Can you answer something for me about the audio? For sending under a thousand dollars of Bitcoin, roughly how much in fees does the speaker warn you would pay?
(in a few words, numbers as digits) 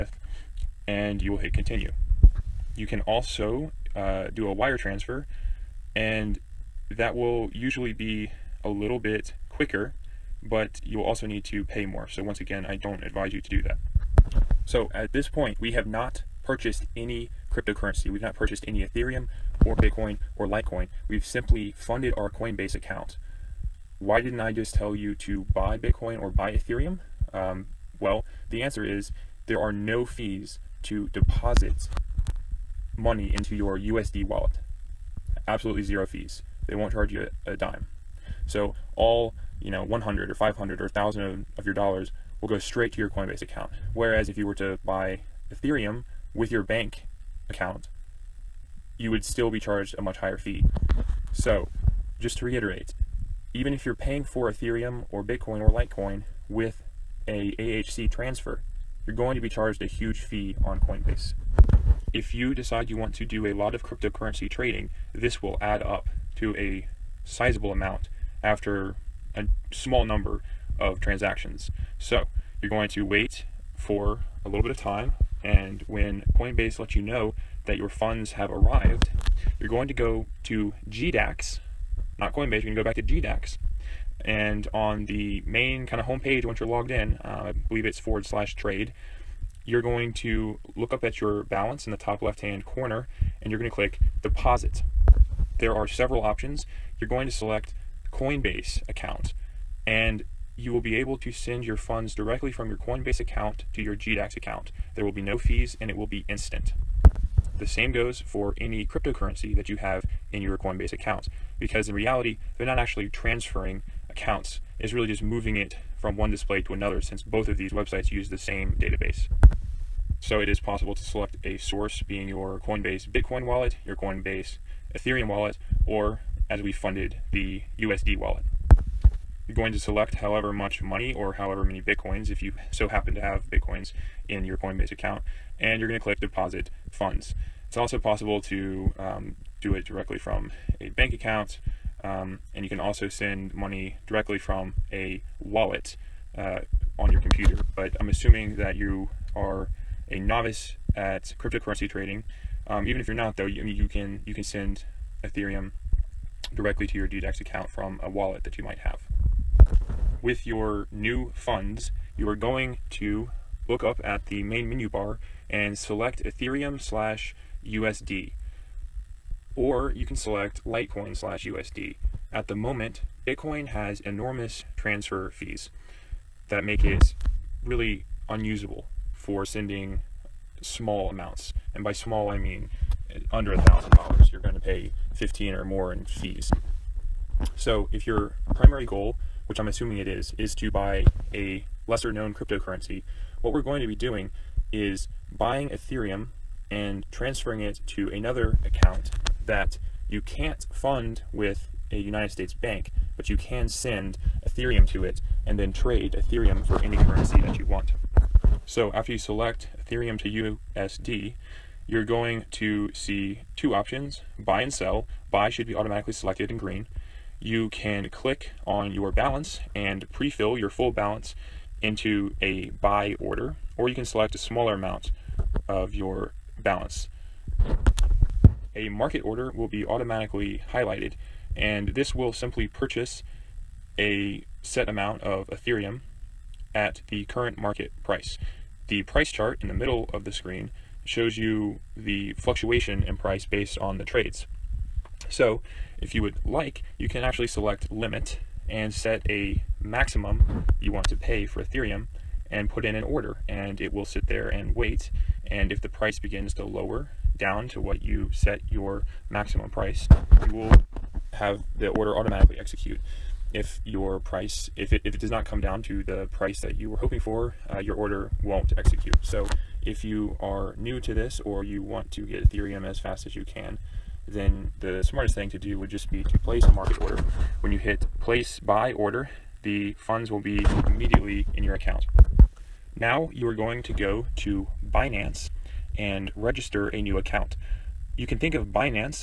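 15 or more.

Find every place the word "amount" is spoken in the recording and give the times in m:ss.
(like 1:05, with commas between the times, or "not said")
1:07, 3:01, 3:44, 3:54.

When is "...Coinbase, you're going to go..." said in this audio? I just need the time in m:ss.
1:22.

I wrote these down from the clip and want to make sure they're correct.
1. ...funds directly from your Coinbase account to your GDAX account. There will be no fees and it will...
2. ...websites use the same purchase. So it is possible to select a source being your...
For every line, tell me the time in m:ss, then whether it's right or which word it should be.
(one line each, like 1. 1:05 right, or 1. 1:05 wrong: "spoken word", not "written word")
1. 1:41 right
2. 1:57 wrong: "database", not "purchase".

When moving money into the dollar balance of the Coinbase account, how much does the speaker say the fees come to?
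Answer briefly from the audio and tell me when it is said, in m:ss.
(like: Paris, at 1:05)
Zero fees, at 0:35.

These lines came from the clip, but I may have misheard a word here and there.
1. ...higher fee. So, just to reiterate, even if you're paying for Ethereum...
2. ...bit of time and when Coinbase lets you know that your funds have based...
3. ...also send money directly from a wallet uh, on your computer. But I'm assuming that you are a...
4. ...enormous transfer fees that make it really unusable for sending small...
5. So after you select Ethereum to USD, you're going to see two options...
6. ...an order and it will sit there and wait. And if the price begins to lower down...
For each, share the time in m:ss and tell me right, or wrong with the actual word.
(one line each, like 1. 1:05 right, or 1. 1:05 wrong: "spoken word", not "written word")
1. 0:50 right
2. 1:14 wrong: "arrived", not "based"
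3. 2:22 right
4. 2:54 right
5. 3:28 right
6. 4:12 right.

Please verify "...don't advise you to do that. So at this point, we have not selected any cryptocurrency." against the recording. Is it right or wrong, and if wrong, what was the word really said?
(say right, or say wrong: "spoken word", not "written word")
wrong: "purchased", not "selected".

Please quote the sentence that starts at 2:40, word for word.
With your new funds, you are going to look up at the main menu bar and select Ethereum slash USD.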